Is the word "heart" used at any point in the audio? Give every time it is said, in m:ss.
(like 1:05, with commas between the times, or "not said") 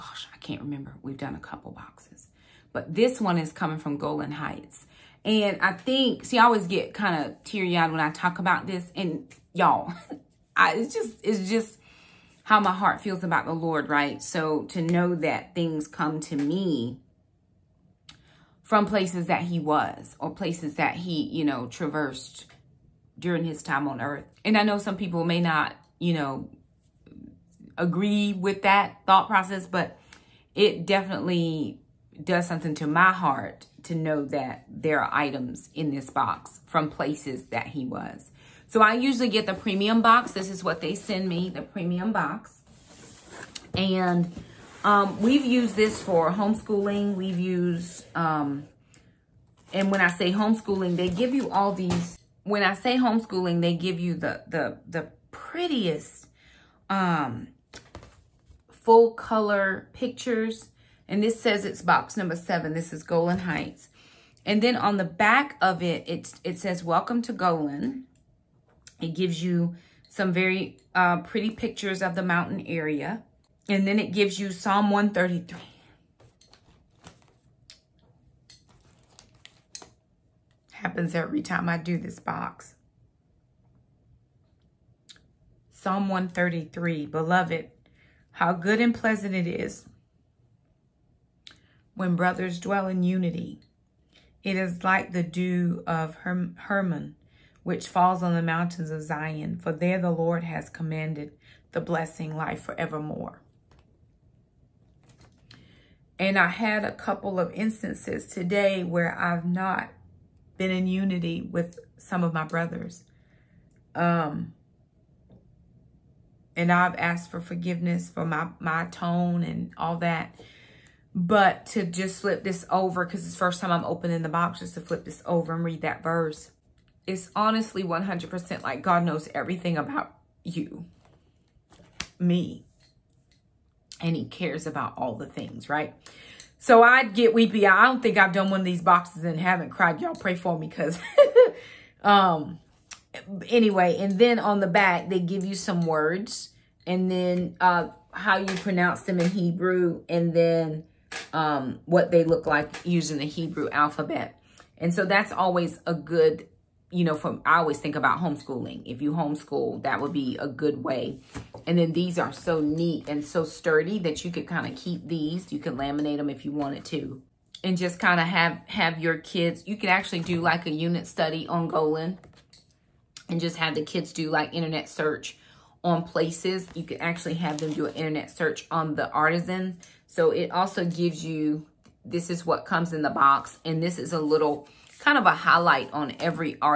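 0:12, 0:33.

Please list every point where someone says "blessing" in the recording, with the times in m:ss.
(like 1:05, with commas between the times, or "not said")
1:41.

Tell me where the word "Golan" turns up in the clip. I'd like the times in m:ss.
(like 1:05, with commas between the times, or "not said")
0:03, 1:03, 1:07, 2:51.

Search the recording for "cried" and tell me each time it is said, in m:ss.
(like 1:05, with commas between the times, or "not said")
2:19.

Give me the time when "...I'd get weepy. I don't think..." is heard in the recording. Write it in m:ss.
2:16.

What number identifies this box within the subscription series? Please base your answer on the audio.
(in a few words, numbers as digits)
7.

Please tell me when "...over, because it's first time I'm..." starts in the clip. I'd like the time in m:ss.
2:02.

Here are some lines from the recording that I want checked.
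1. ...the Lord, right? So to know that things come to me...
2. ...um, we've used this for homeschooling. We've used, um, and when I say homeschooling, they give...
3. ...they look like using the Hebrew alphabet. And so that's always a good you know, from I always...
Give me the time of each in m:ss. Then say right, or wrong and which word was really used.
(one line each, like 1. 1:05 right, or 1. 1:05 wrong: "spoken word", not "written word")
1. 0:13 right
2. 0:44 right
3. 2:32 right.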